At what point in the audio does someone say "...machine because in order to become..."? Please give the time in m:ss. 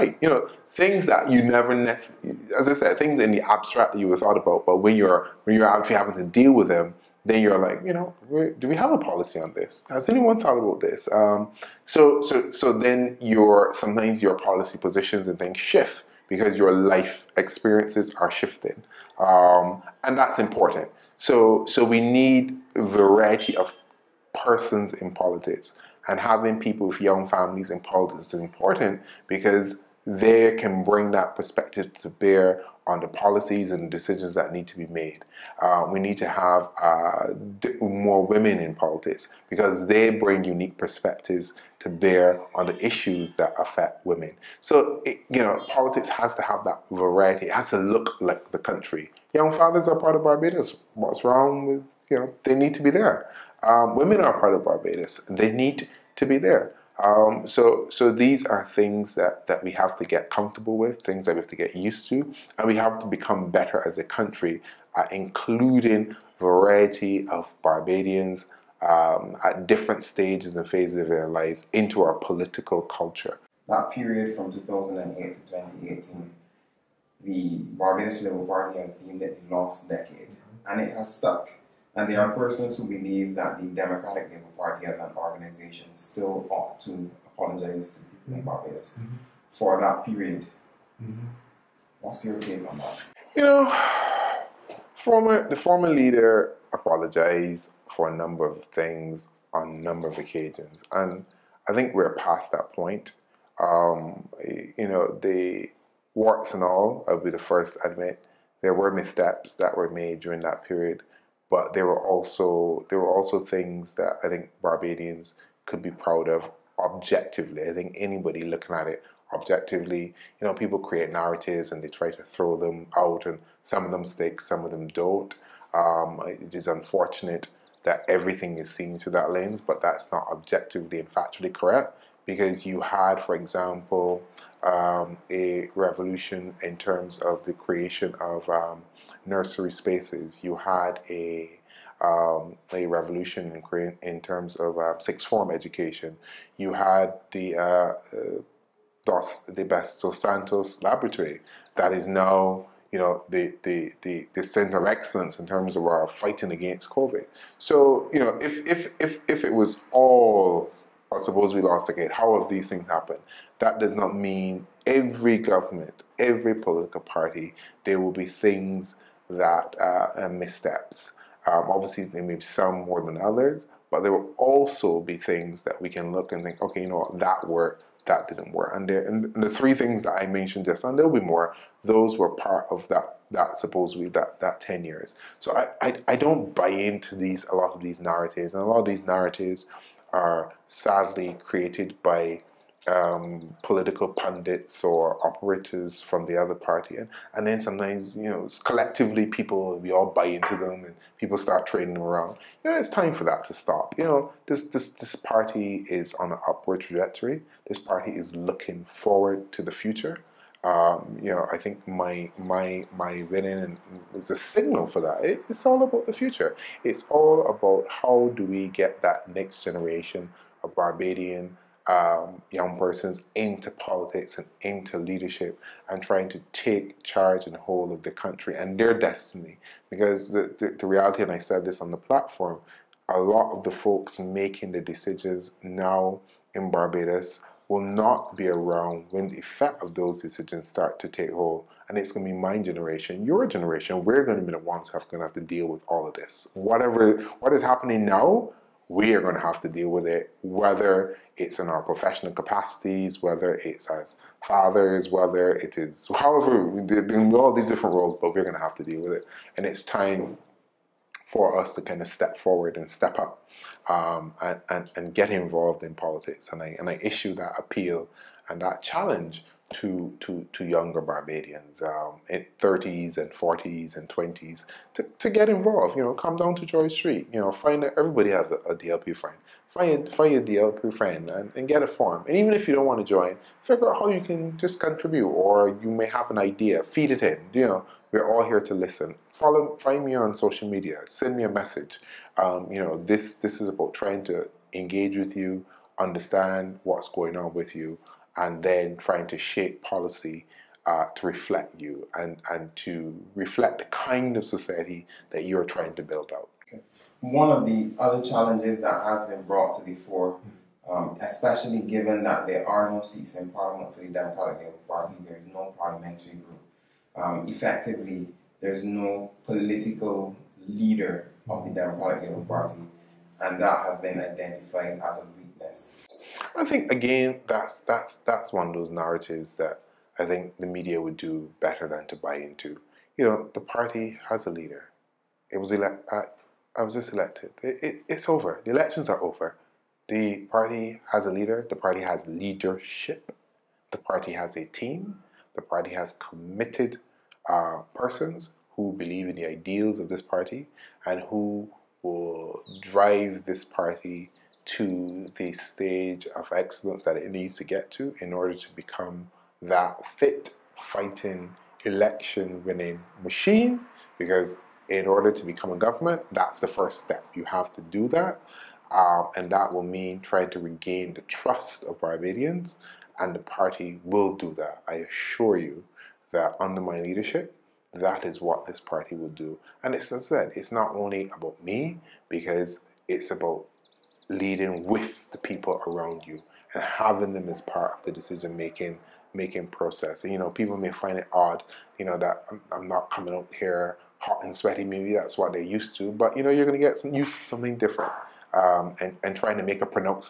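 6:03.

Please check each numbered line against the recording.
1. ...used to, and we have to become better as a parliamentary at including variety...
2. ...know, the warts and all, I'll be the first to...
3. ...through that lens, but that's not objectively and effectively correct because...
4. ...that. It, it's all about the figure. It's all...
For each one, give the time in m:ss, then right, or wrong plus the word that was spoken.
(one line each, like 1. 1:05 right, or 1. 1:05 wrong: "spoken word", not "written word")
1. 1:01 wrong: "country", not "parliamentary"
2. 1:44 right
3. 2:08 wrong: "factually", not "effectively"
4. 3:35 wrong: "future", not "figure".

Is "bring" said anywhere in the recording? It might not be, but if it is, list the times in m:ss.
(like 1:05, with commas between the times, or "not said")
0:30, 0:40.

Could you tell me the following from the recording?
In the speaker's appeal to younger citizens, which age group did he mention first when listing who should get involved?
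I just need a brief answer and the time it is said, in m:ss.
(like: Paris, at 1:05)
30s, at 4:32.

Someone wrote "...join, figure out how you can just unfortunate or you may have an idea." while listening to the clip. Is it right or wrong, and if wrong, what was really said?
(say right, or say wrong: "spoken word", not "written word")
wrong: "contribute", not "unfortunate".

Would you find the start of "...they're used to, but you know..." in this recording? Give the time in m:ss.
6:35.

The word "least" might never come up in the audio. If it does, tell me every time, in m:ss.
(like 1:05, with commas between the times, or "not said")
not said.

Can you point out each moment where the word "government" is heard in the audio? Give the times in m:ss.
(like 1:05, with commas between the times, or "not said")
2:45, 6:05.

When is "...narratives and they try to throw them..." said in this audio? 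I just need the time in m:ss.
2:01.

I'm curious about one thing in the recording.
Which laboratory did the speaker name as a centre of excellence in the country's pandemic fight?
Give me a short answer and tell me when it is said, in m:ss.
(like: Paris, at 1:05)
Dos Santos Laboratory, at 2:29.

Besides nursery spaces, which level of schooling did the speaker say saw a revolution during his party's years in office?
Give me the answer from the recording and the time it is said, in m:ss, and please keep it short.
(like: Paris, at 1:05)
sixth form education, at 2:24.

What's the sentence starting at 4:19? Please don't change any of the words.
And it's time for us to kind of step forward and step up um, and, and, and, get involved in politics.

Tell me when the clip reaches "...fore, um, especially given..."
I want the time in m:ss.
5:09.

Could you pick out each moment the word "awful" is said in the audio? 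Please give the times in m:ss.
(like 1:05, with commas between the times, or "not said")
not said.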